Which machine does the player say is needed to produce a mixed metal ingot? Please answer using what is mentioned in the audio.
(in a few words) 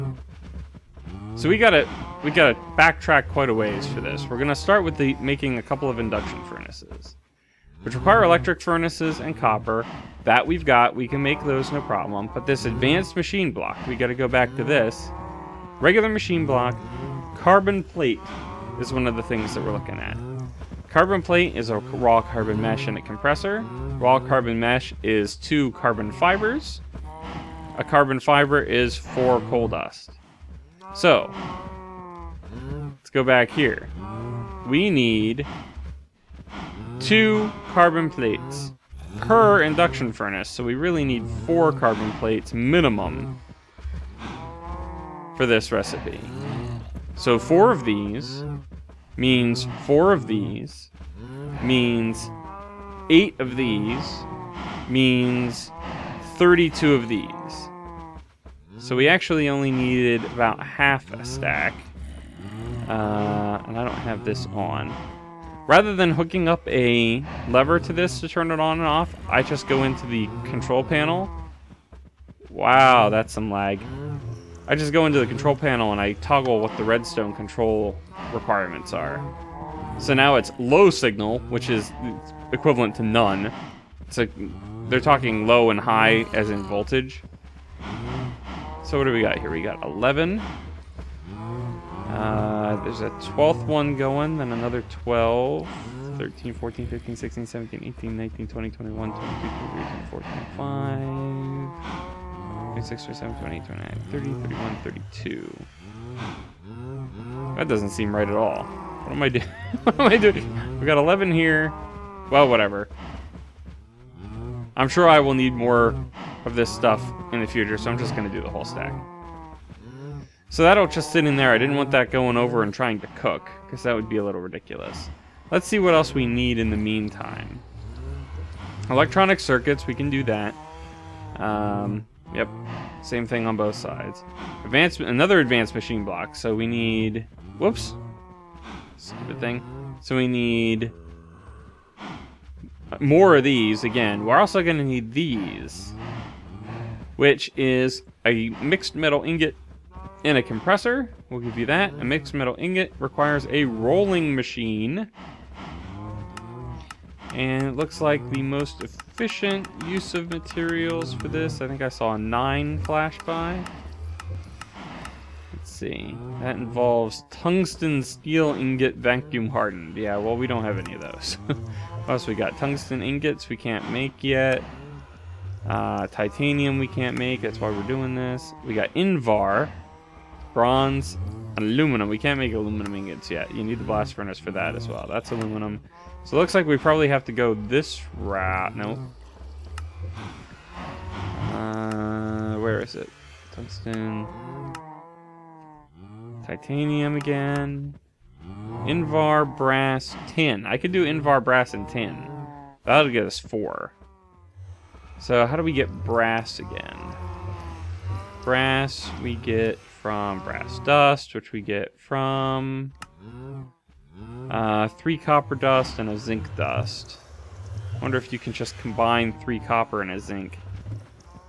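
rolling machine.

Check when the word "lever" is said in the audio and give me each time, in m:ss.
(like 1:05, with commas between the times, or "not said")
1:07.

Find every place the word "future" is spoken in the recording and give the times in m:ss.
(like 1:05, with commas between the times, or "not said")
1:57.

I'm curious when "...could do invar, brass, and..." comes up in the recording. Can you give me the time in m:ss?
3:20.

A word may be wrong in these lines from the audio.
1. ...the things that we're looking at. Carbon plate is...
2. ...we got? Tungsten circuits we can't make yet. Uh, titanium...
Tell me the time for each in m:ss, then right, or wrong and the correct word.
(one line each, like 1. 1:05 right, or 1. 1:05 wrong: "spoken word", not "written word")
1. 0:19 right
2. 2:52 wrong: "ingots", not "circuits".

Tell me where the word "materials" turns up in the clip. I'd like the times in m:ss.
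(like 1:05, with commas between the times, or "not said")
2:40.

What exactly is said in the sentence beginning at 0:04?
We're gonna start with the making a couple of induction furnaces, which require electric furnaces and copper.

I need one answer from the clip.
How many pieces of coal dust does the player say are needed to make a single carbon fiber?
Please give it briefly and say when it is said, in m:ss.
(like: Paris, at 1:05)
4, at 0:28.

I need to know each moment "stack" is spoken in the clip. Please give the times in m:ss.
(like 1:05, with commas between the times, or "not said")
1:01, 1:58.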